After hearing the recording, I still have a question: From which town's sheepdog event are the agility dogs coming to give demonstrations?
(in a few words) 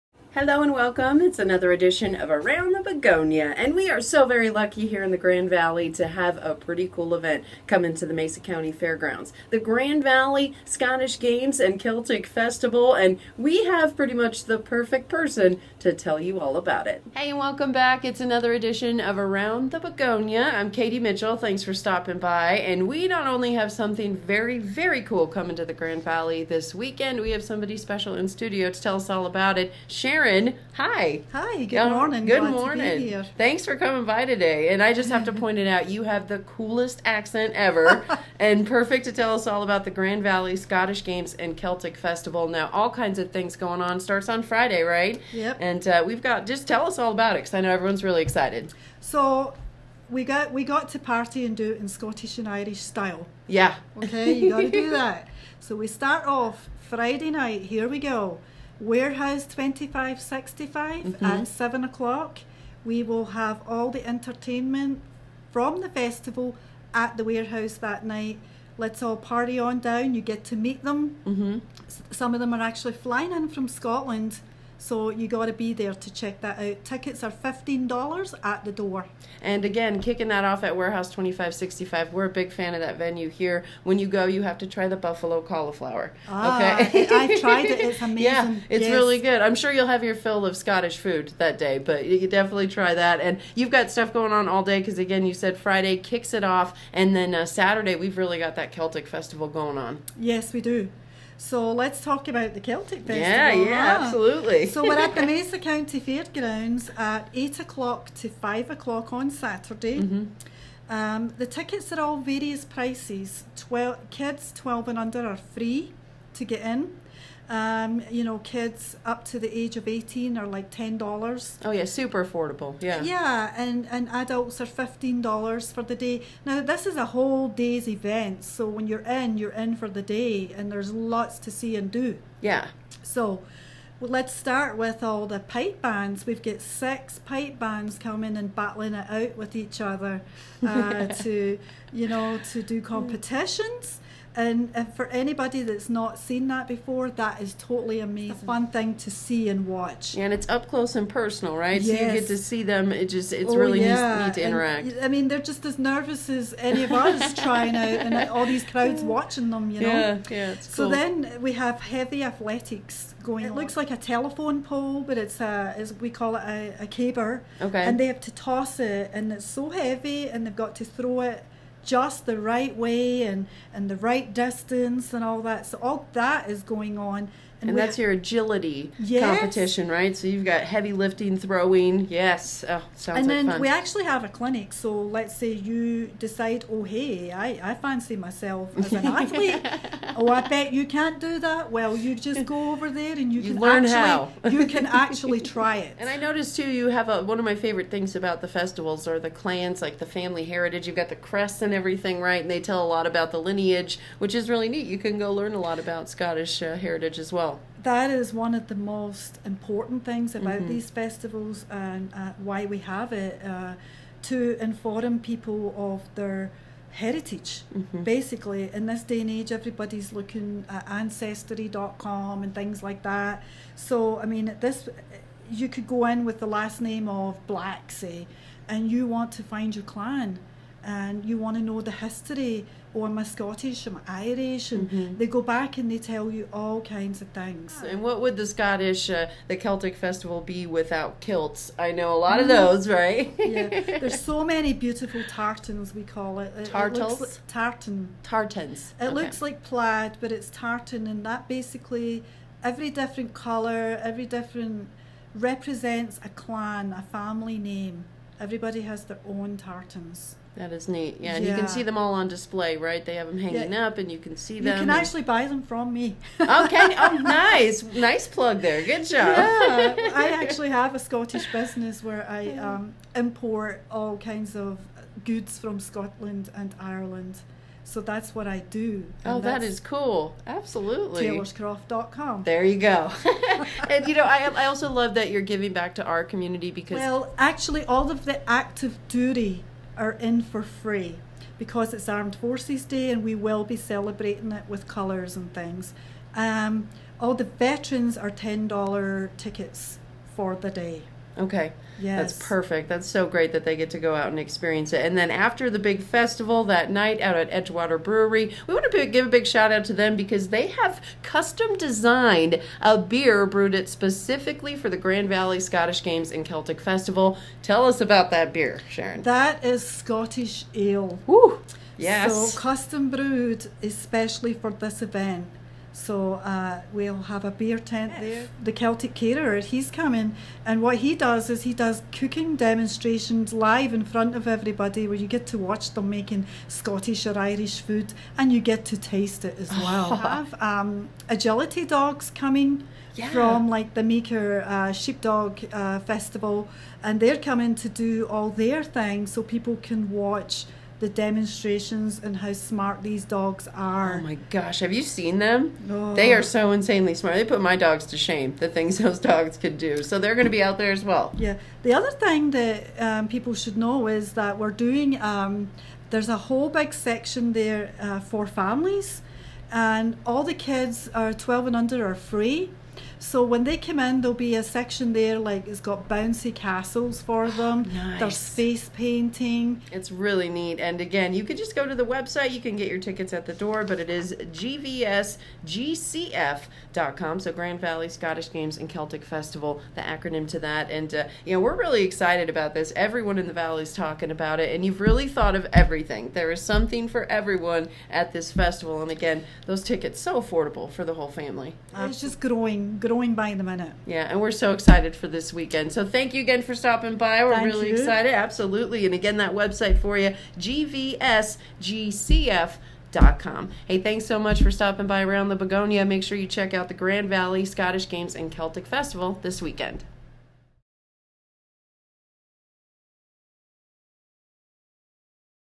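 Meeker.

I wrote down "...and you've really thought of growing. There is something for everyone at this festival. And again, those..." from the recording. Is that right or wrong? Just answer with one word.
wrong.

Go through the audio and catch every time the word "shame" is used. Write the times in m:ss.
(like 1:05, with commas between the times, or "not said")
5:58.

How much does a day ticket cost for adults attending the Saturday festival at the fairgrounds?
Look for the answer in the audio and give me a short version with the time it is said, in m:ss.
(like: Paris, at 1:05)
$15, at 2:04.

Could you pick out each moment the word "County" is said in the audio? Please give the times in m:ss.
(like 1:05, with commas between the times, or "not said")
0:08, 1:45.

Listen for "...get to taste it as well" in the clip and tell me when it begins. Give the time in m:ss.
5:38.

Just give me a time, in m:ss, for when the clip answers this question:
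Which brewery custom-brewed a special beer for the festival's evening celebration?
5:07.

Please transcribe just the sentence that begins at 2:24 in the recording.
And for anybody that's not seen that before, that is totally amazing.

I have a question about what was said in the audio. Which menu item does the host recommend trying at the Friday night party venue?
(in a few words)
Buffalo cauliflower.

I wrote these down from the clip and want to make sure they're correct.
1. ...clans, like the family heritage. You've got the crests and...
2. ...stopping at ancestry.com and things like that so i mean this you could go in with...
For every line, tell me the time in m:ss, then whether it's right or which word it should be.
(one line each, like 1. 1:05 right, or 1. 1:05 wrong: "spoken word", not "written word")
1. 3:19 right
2. 3:40 wrong: "looking", not "stopping".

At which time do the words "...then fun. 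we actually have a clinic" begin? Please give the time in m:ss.
3:03.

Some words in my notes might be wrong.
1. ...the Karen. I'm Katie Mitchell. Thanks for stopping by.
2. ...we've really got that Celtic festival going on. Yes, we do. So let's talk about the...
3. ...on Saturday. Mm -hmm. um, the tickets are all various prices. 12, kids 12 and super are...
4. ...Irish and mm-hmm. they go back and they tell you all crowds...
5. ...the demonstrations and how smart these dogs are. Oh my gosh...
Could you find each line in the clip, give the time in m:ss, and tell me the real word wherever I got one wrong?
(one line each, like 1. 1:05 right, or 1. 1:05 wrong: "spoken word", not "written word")
1. 0:19 wrong: "Begonia", not "Karen"
2. 1:37 right
3. 1:49 wrong: "under", not "super"
4. 3:54 wrong: "kinds", not "crowds"
5. 5:51 right.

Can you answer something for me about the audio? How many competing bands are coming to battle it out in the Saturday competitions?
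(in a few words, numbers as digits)
6.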